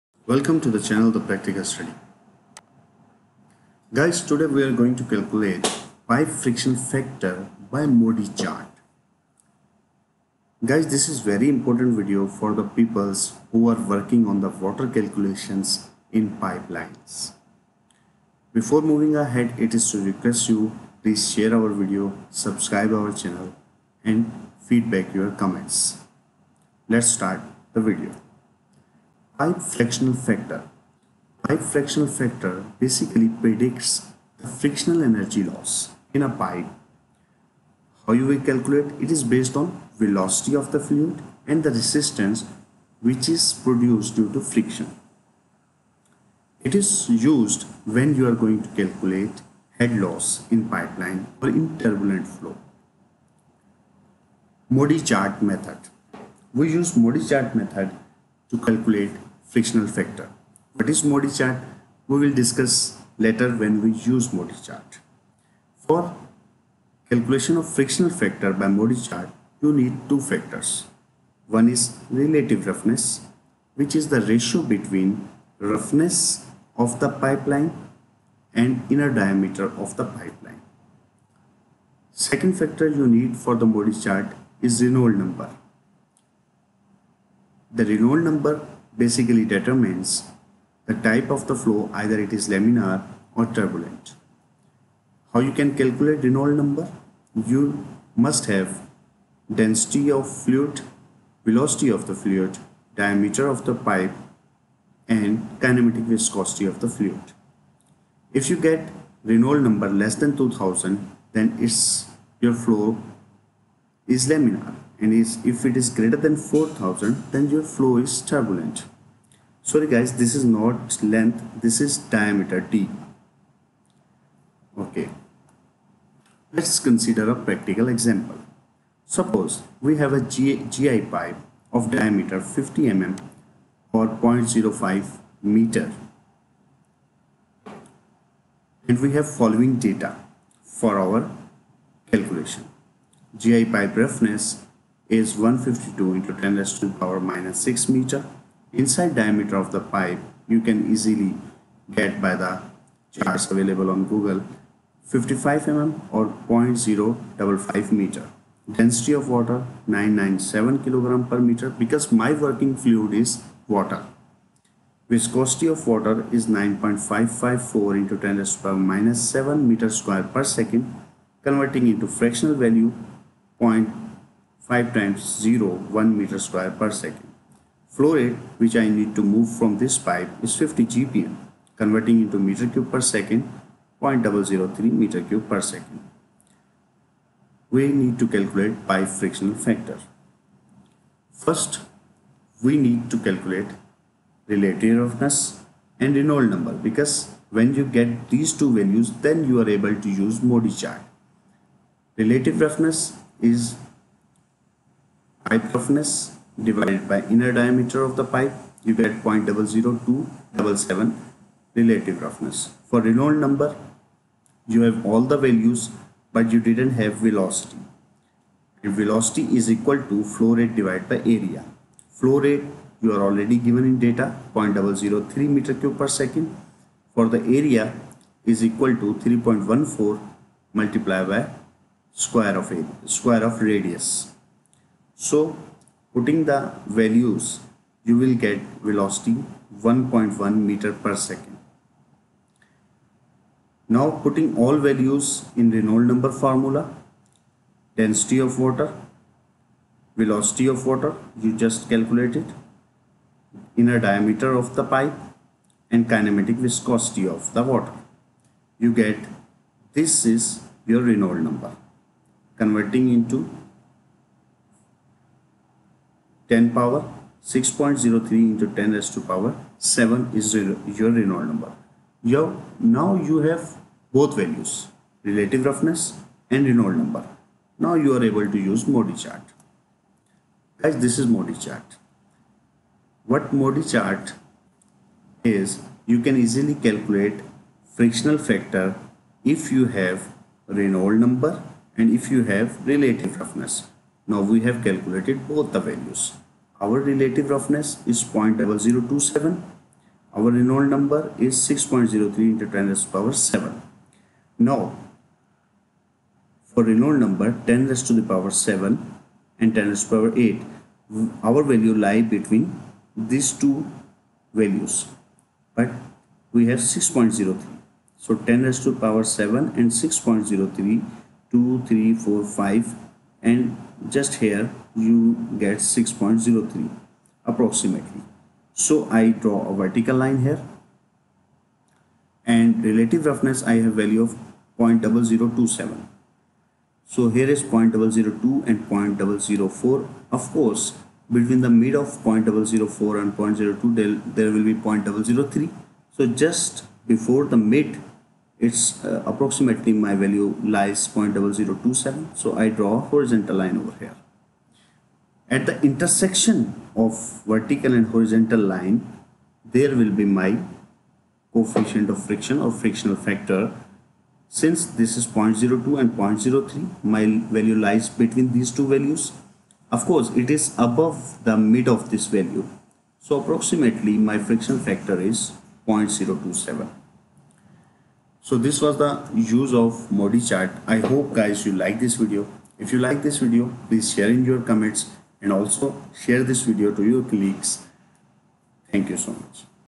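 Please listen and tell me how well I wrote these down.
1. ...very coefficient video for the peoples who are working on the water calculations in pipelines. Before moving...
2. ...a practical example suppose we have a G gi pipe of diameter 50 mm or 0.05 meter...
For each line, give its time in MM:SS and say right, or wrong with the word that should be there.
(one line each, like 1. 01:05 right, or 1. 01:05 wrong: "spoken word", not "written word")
1. 00:11 wrong: "important", not "coefficient"
2. 02:07 right.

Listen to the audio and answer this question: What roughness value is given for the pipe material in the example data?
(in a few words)
152 x 10^-6 meter.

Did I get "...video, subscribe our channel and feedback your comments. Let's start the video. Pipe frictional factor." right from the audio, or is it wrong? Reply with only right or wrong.
right.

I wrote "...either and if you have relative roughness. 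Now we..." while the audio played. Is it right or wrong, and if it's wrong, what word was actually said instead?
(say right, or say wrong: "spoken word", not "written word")
wrong: "number", not "either".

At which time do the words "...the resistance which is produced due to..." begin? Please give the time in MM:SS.
00:41.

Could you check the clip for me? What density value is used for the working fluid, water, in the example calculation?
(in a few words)
997 kg/m3.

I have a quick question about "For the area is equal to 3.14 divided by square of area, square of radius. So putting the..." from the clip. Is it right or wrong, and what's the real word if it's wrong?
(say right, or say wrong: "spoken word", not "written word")
wrong: "multiplied", not "divided".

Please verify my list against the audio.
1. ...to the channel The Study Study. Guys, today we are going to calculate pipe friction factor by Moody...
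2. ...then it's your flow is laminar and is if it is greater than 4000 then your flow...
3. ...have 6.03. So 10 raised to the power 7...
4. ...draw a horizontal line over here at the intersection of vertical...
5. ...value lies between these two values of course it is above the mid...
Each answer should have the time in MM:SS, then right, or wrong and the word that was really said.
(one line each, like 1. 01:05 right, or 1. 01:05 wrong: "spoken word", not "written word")
1. 00:00 wrong: "Practical", not "Study"
2. 01:51 right
3. 05:16 right
4. 05:52 right
5. 06:07 right.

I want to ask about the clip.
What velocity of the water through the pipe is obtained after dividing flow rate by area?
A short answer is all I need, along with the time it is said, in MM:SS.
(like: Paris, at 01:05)
1.1 m/s, at 03:59.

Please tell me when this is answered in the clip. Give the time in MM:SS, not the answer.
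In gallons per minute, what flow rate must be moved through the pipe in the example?
03:00.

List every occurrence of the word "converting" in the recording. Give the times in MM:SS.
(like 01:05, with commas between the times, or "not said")
02:51, 03:01, 04:22.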